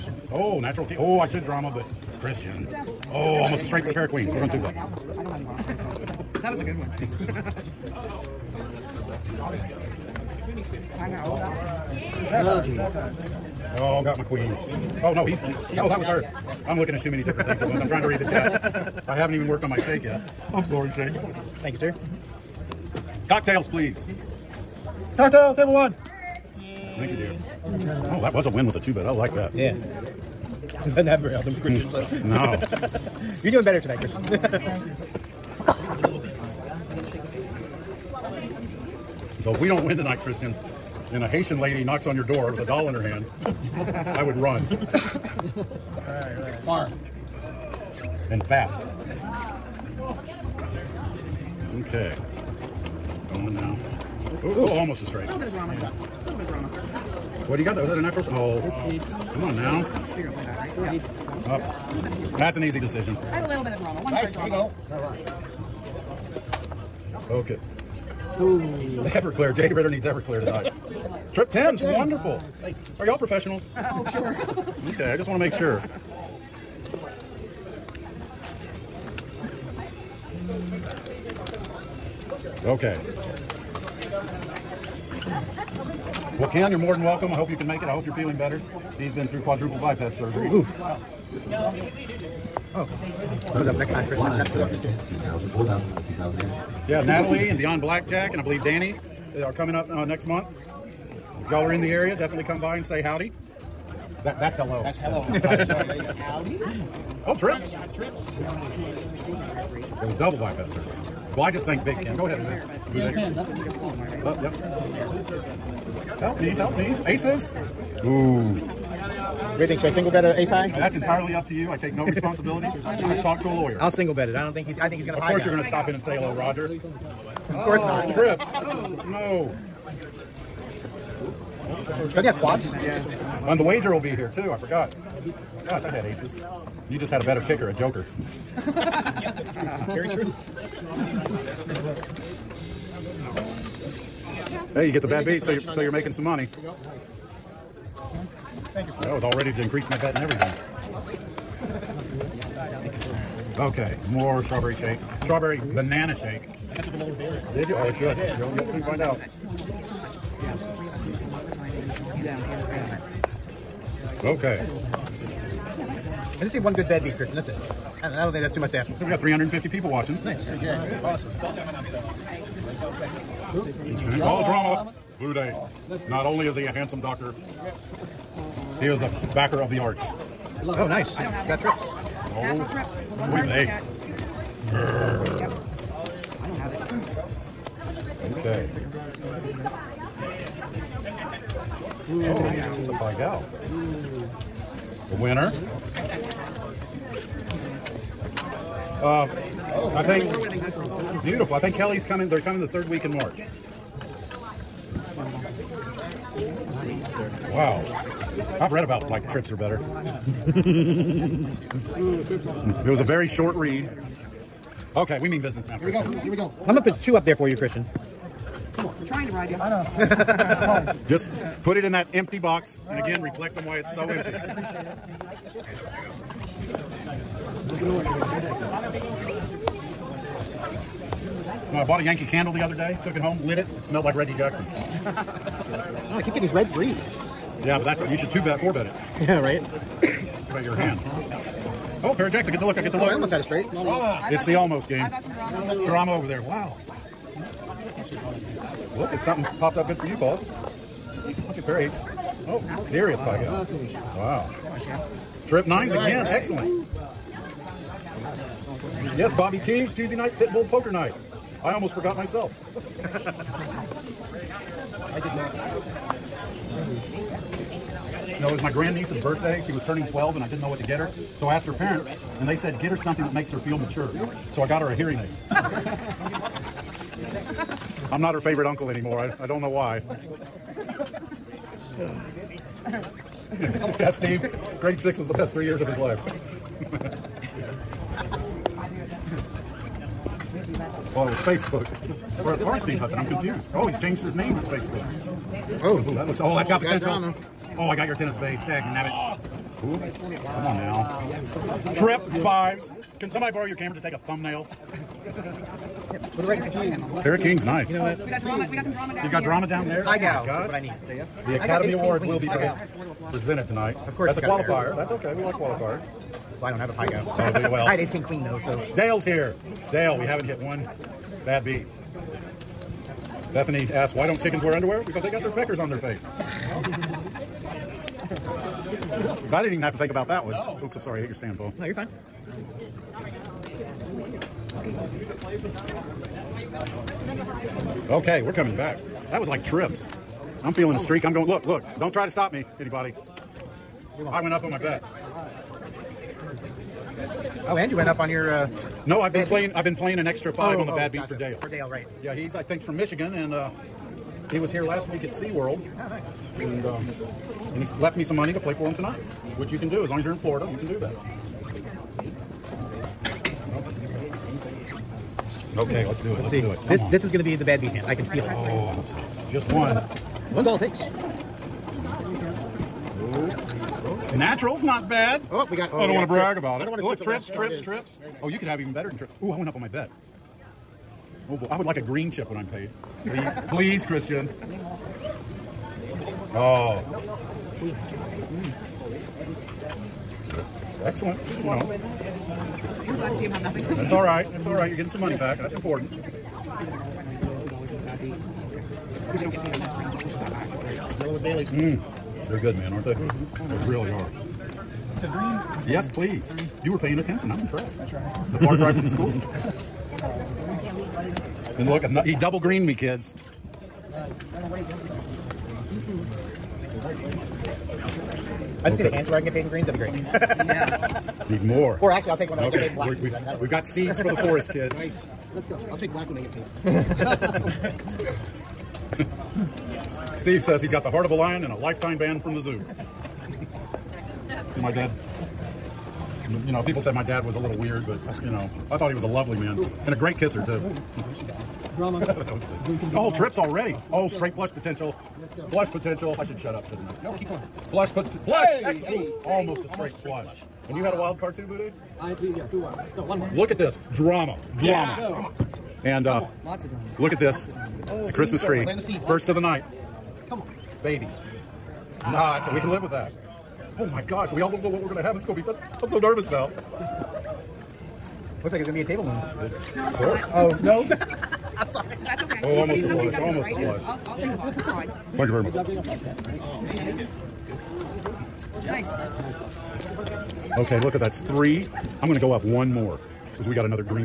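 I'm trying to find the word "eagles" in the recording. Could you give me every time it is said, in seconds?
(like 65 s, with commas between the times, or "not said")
not said.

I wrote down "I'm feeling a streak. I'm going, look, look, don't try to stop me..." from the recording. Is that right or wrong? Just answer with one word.
right.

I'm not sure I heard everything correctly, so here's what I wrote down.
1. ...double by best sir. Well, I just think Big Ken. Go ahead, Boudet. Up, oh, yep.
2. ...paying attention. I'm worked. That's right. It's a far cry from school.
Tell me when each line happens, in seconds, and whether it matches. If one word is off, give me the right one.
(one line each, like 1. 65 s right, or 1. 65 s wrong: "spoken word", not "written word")
1. 110 s right
2. 406 s wrong: "impressed", not "worked".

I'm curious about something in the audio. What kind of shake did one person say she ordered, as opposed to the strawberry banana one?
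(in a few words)
Vanilla with berries.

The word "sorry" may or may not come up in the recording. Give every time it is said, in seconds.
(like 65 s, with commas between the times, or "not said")
20 s, 331 s, 471 s.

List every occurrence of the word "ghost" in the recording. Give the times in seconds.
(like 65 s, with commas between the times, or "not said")
not said.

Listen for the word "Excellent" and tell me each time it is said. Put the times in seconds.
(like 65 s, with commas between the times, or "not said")
256 s, 391 s, 448 s.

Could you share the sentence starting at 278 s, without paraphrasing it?
I'm not her favorite uncle anymore.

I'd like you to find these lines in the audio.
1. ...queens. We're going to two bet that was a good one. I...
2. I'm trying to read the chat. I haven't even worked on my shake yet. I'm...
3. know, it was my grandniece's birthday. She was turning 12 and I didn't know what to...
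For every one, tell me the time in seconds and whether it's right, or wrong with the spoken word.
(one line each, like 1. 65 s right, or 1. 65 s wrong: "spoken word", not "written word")
1. 4 s right
2. 17 s right
3. 268 s right.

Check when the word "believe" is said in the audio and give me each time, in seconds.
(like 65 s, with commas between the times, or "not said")
98 s.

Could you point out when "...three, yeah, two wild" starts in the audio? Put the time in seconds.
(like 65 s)
452 s.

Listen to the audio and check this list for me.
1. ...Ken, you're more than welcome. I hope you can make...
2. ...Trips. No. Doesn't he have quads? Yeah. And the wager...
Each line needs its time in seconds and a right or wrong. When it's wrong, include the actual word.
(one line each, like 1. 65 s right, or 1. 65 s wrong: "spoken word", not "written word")
1. 86 s right
2. 128 s right.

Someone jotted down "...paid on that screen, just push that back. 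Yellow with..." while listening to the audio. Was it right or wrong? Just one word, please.
right.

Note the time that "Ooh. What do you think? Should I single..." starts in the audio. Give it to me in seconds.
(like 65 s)
118 s.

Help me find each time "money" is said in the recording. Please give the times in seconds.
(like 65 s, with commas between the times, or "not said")
146 s, 358 s, 395 s.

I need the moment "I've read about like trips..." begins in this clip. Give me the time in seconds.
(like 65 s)
208 s.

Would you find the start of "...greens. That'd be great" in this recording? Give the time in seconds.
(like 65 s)
419 s.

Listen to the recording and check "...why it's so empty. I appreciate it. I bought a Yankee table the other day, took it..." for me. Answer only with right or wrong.
wrong.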